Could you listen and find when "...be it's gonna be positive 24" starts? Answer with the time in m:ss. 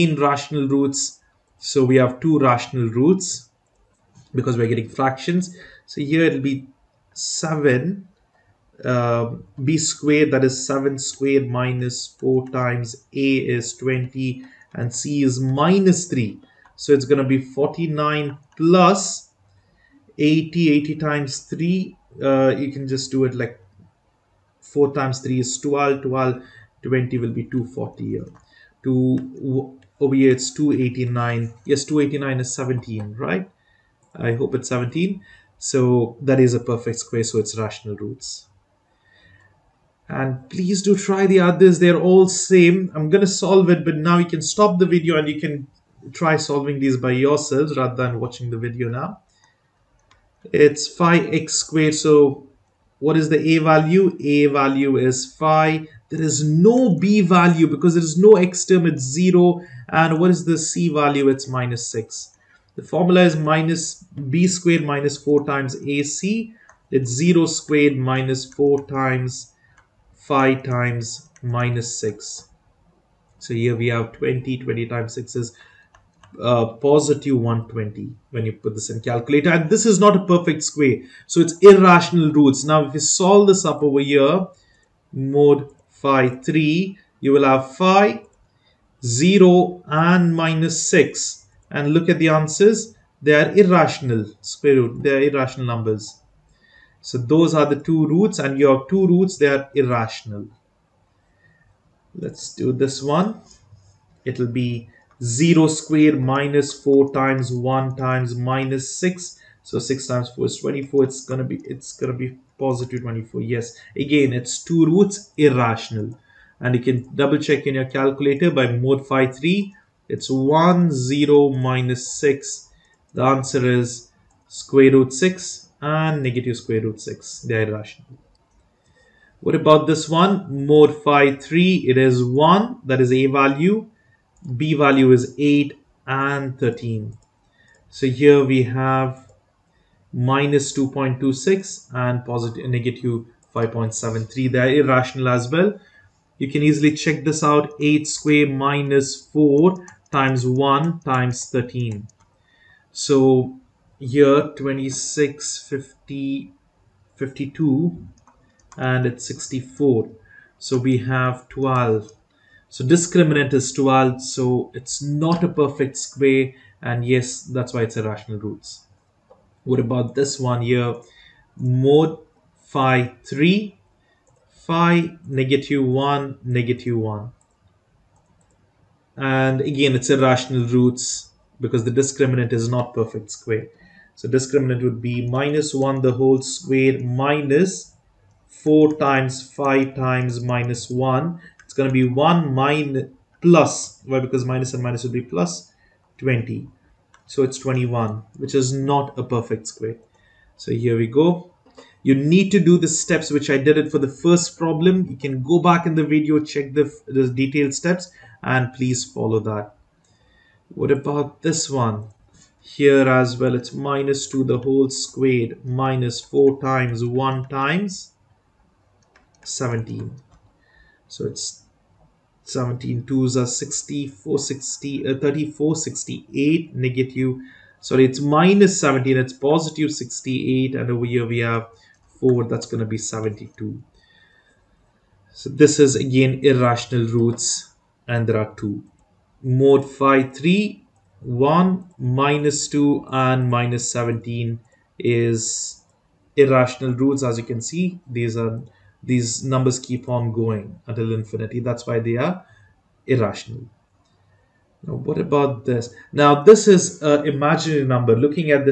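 1:51.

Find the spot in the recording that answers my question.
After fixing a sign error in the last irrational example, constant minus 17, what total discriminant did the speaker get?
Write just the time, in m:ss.
3:52.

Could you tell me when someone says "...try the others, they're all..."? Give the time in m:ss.
0:40.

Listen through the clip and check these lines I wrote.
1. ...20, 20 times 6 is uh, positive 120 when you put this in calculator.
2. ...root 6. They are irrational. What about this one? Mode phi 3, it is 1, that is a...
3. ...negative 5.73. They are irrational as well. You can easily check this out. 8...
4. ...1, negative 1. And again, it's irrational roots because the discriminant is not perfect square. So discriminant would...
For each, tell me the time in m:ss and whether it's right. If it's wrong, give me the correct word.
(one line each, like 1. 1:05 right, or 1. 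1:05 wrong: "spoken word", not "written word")
1. 1:14 right
2. 2:06 right
3. 2:22 right
4. 2:55 right.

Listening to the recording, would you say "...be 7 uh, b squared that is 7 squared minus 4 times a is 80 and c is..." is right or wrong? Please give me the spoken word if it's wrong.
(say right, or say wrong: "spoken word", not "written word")
wrong: "20", not "80".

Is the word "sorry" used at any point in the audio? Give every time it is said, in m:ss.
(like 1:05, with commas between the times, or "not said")
3:47.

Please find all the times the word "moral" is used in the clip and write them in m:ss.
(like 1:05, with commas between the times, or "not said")
not said.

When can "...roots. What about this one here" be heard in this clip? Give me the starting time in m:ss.
2:48.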